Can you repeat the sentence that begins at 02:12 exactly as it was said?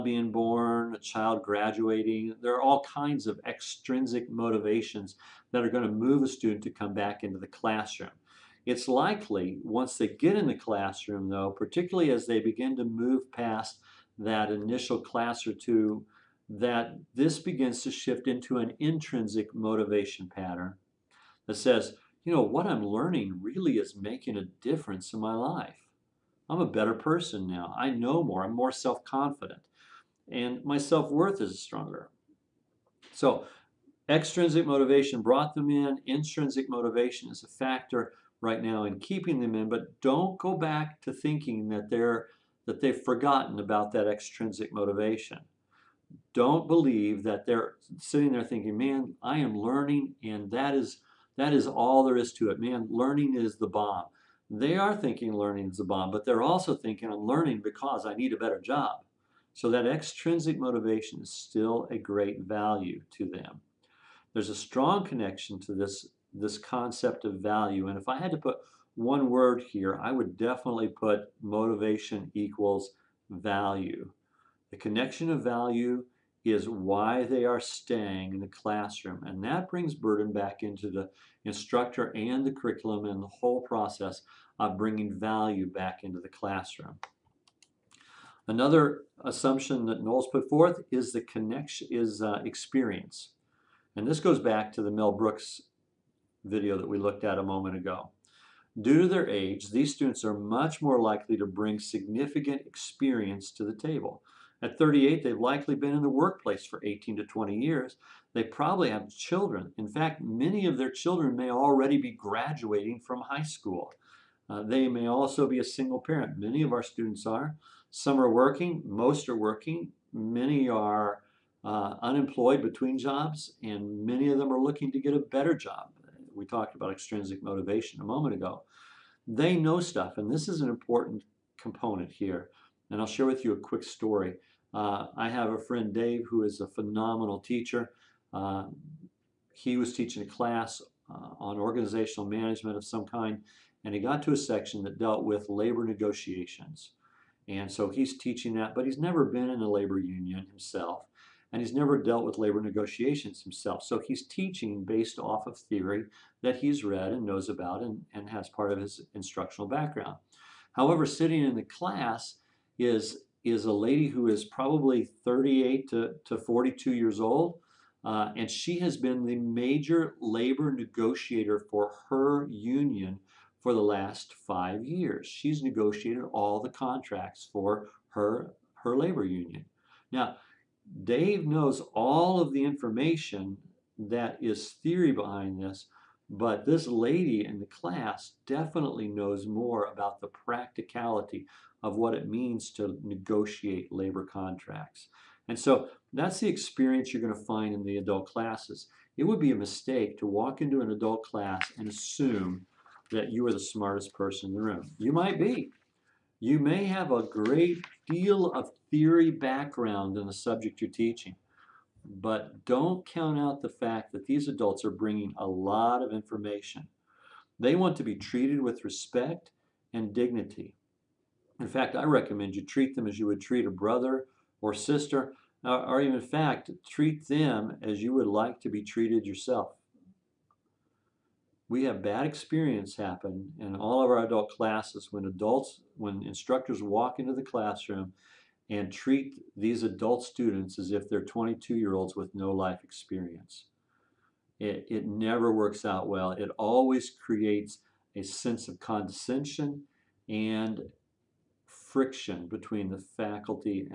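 And I'll share with you a quick story.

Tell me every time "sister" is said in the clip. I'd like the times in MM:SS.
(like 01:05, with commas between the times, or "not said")
03:44.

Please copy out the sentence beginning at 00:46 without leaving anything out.
Don't believe that they're sitting there thinking, "Man, I am learning and that is that is all there is to it.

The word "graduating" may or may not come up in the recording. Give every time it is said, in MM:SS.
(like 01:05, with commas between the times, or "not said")
00:01, 01:52.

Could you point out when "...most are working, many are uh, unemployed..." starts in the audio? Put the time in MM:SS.
01:58.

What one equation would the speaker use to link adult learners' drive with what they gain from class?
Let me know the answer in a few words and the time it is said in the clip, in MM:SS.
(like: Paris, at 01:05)
motivation equals value, at 01:11.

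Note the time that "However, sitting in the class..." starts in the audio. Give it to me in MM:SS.
02:40.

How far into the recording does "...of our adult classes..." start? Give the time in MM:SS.
03:54.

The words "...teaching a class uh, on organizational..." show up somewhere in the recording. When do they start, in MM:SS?
02:19.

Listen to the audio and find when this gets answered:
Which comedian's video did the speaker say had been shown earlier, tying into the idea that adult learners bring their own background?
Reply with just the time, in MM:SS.
01:34.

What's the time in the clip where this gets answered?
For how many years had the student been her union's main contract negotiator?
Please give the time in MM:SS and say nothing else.
02:54.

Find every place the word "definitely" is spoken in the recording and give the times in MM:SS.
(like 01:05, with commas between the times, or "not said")
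01:10, 03:08.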